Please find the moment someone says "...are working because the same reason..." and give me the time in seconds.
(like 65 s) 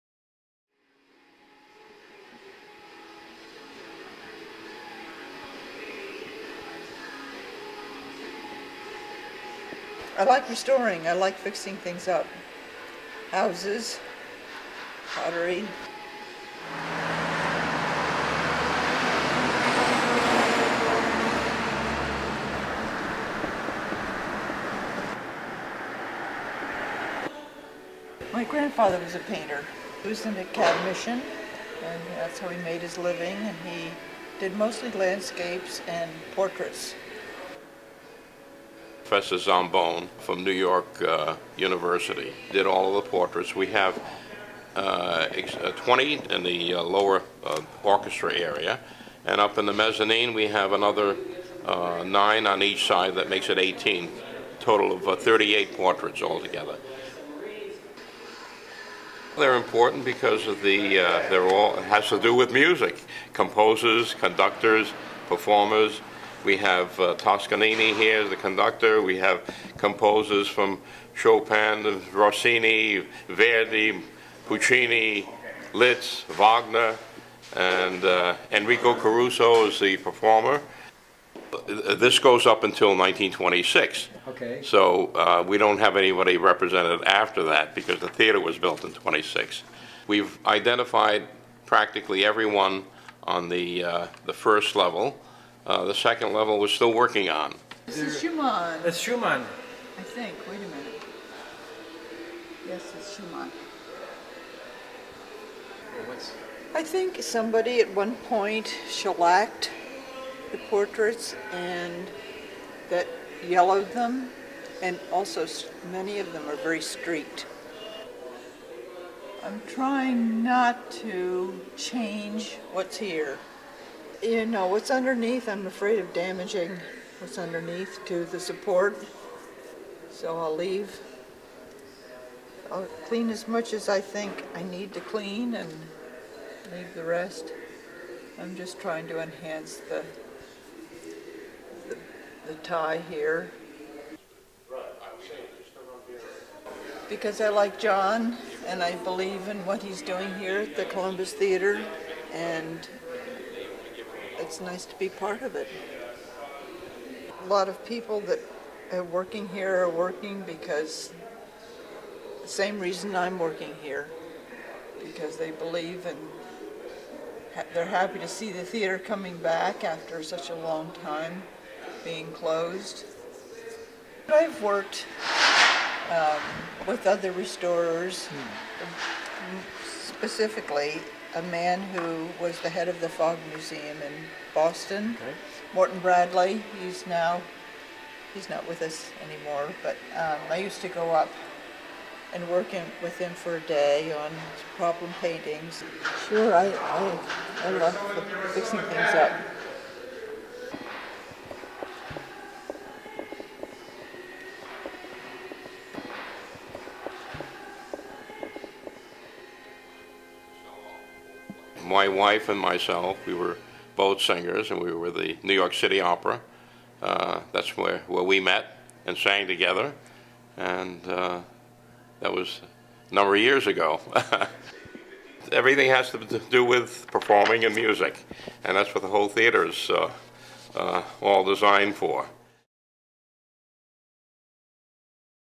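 159 s.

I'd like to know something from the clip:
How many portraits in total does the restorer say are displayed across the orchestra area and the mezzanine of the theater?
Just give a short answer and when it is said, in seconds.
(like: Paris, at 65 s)
38, at 55 s.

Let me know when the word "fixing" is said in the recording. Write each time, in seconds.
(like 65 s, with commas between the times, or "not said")
11 s, 198 s.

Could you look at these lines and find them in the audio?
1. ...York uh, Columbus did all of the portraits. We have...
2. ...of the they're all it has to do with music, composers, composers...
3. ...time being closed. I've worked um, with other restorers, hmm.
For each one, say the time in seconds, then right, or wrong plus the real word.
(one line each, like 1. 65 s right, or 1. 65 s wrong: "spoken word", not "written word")
1. 40 s wrong: "University", not "Columbus"
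2. 60 s wrong: "conductors", not "composers"
3. 171 s right.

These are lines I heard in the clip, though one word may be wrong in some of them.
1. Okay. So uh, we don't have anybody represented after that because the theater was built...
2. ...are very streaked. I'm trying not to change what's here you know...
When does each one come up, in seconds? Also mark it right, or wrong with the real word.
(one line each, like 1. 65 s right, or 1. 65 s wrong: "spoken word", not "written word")
1. 84 s right
2. 116 s right.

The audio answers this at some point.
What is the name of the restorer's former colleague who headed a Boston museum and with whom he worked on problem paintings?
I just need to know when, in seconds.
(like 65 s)
185 s.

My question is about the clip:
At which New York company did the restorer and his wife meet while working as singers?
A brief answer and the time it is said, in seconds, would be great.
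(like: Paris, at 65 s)
New York City Opera, at 215 s.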